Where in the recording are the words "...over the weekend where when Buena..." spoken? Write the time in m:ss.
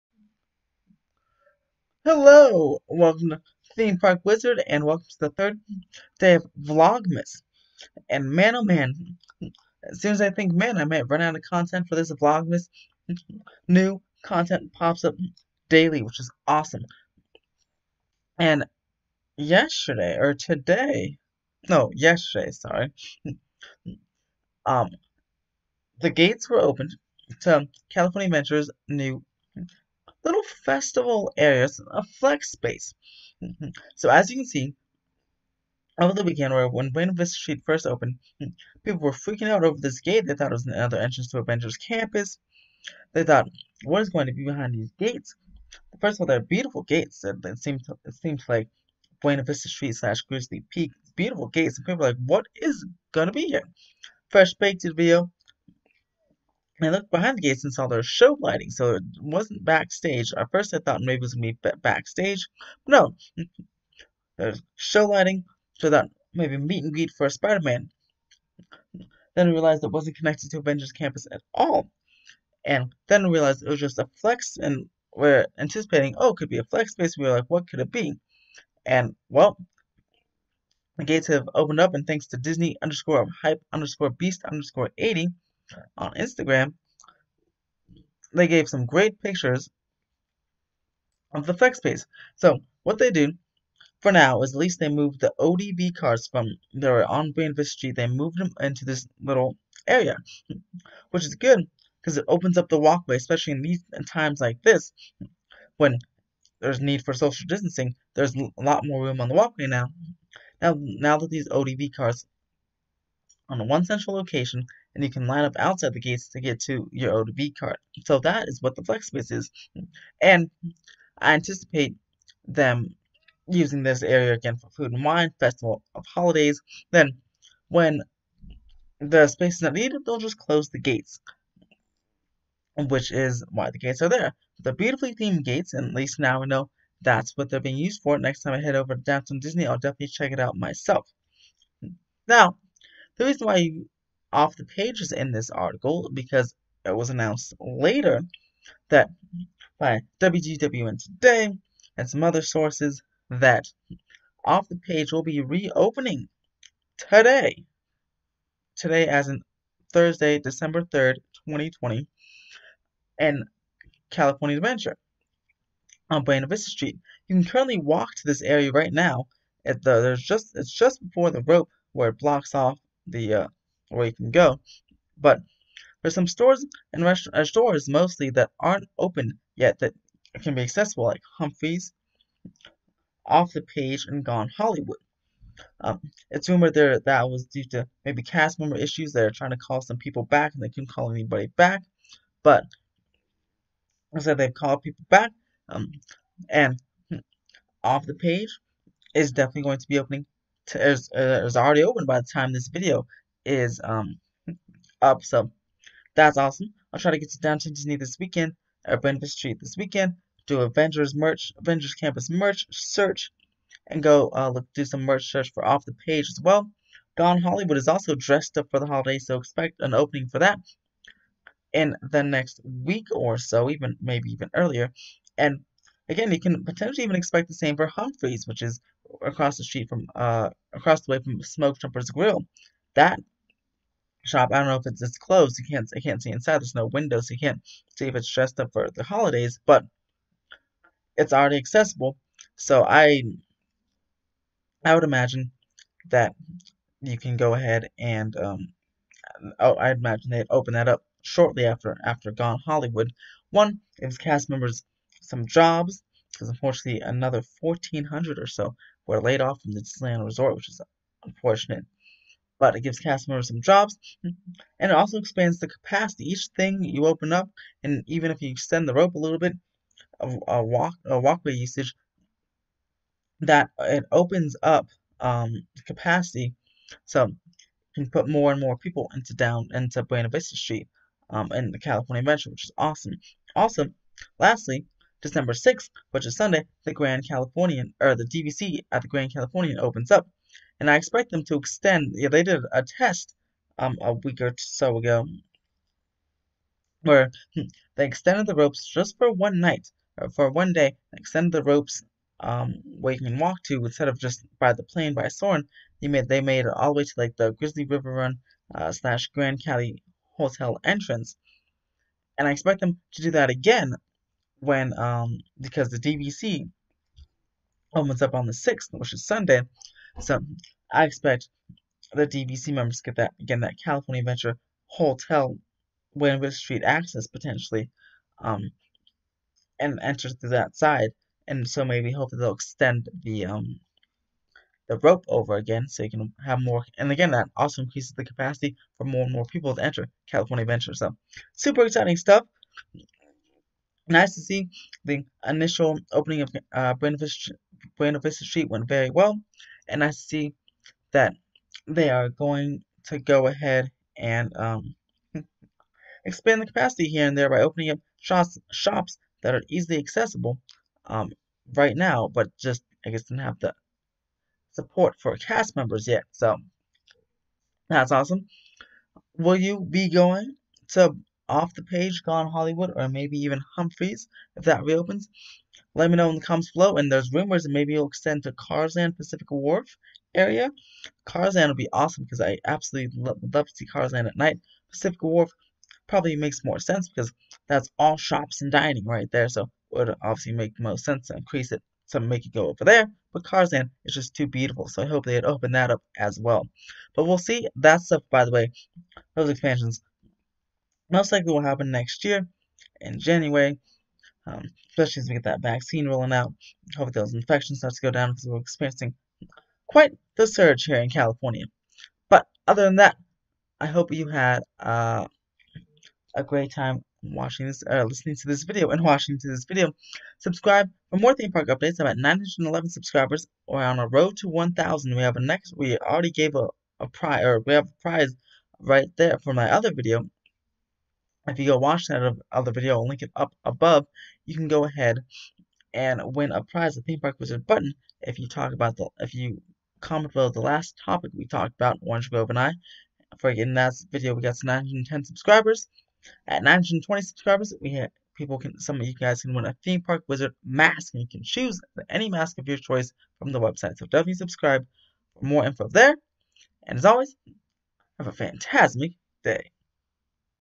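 0:35.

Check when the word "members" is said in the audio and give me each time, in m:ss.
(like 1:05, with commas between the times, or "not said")
3:08, 4:14, 4:23, 5:22, 6:05.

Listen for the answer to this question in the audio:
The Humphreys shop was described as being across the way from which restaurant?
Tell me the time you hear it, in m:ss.
3:51.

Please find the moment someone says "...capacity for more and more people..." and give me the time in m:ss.
5:38.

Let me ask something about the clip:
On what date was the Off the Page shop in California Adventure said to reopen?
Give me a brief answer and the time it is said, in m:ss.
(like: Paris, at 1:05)
December 3rd, 2020, at 2:39.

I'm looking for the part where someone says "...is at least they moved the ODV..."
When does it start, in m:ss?
1:34.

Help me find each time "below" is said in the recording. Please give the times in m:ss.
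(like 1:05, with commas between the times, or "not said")
6:16, 7:20.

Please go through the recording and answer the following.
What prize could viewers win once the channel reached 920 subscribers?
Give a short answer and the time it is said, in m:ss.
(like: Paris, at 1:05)
Theme Park Wizard mask, at 7:29.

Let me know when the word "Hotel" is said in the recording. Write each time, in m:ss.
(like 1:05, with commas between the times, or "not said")
5:10, 5:24.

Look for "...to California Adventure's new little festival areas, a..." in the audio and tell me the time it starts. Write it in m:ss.
0:27.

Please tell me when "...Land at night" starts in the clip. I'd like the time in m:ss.
6:24.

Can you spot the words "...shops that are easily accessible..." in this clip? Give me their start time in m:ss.
5:58.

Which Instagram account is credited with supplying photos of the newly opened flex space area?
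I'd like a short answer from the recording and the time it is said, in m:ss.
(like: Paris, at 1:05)
disney_hype_beast_80, at 1:22.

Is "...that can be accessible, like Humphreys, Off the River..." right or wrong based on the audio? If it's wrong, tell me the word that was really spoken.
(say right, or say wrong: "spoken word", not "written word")
wrong: "Page", not "River".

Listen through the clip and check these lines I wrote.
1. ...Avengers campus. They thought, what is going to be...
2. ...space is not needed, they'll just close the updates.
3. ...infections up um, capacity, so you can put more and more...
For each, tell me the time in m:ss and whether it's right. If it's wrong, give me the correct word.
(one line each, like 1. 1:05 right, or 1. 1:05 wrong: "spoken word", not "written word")
1. 0:41 right
2. 2:09 wrong: "gates", not "updates"
3. 4:34 wrong: "opens", not "infections".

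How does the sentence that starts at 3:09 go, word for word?
They're trying to call some people back and they couldn't call anybody back.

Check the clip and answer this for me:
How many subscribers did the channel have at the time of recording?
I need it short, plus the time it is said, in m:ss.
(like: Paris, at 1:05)
911, at 7:02.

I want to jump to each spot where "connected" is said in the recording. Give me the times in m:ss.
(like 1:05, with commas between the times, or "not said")
1:10.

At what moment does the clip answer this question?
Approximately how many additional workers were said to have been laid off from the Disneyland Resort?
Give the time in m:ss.
4:17.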